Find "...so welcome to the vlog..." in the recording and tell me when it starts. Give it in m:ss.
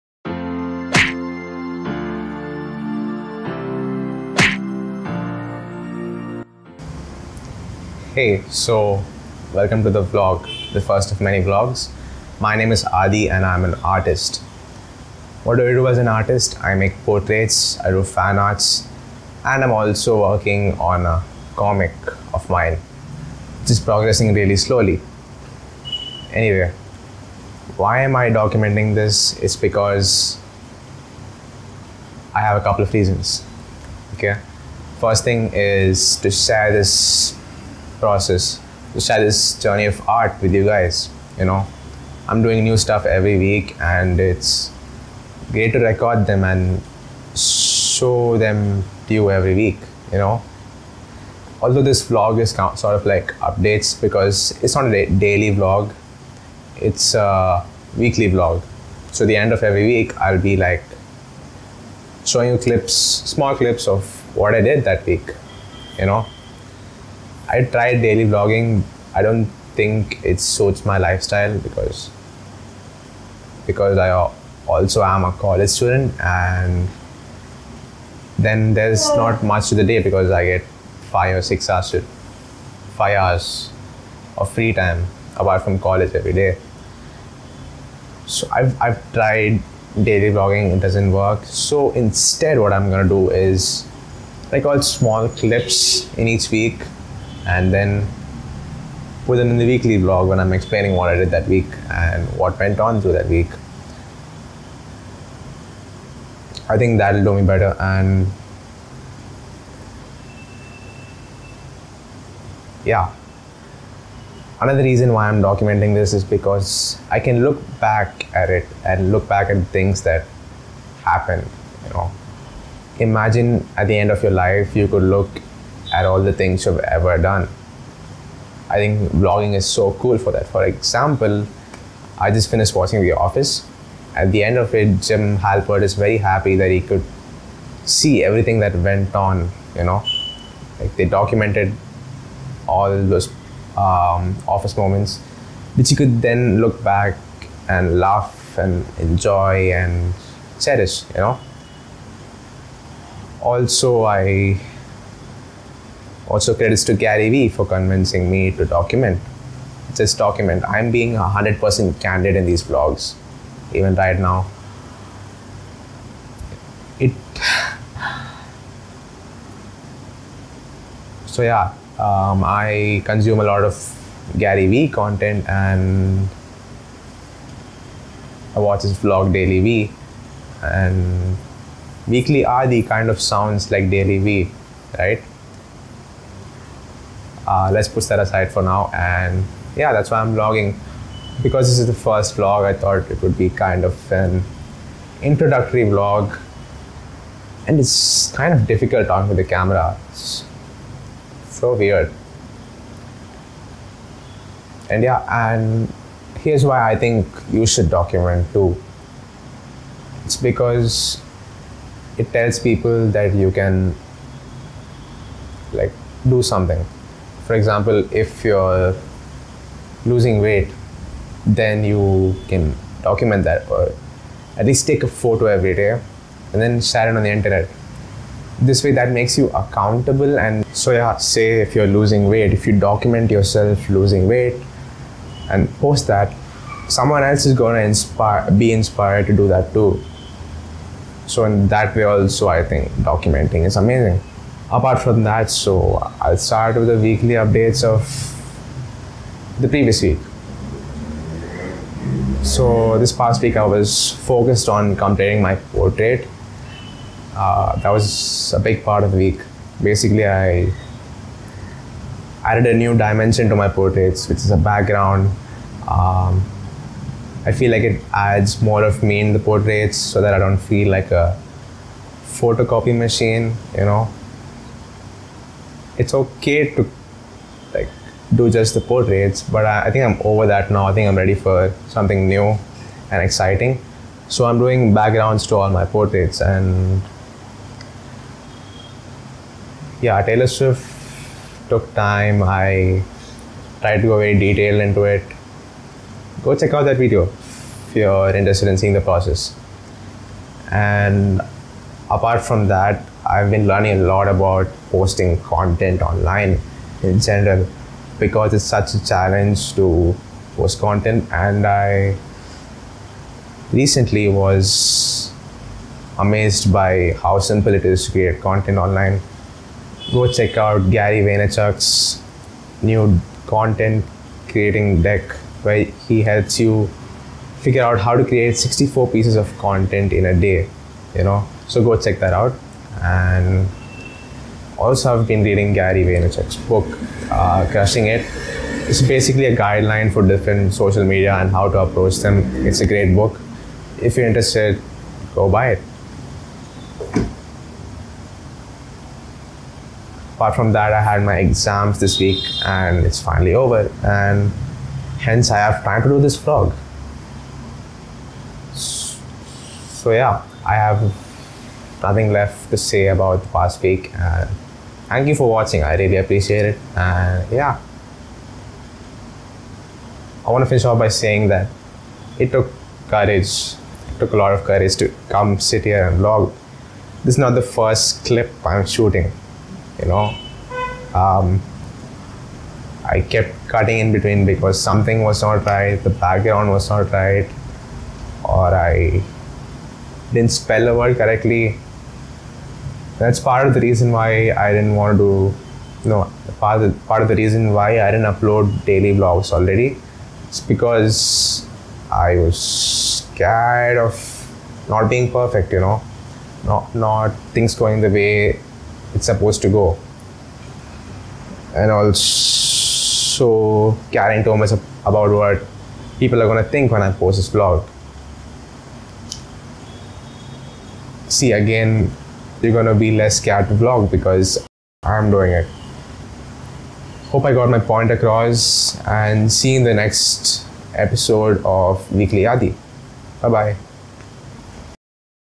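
0:08.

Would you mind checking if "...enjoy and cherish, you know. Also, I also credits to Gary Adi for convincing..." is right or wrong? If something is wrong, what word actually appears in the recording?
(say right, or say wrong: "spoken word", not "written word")
wrong: "Vee", not "Adi".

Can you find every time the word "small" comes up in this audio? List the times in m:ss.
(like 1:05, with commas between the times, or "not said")
1:03, 1:34.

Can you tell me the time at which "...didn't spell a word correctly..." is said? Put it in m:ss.
6:30.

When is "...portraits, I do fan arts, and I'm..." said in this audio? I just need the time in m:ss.
0:17.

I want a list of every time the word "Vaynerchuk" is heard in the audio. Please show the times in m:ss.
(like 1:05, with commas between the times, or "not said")
5:21, 5:36.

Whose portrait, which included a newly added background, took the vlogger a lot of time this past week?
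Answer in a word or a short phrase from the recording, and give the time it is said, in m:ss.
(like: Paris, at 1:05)
Taylor Swift, at 4:50.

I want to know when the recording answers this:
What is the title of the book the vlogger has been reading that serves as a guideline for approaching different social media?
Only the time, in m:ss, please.
5:37.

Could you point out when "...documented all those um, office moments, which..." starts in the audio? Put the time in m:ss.
2:21.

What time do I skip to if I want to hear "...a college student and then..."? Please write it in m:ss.
1:15.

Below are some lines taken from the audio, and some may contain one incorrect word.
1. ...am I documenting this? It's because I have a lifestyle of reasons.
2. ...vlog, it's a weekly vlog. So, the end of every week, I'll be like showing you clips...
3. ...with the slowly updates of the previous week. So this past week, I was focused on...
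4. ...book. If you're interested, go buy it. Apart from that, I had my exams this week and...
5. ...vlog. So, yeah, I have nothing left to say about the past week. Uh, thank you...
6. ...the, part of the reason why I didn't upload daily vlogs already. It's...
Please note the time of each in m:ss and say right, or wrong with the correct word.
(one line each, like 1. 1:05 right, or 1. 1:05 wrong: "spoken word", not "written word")
1. 0:28 wrong: "couple", not "lifestyle"
2. 0:55 right
3. 4:06 wrong: "weekly", not "slowly"
4. 5:43 right
5. 5:56 right
6. 6:36 right.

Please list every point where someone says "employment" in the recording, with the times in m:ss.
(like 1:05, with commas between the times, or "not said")
not said.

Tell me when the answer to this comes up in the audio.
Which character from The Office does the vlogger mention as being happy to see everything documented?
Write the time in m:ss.
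2:15.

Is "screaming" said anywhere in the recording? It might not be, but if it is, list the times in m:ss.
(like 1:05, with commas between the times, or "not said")
not said.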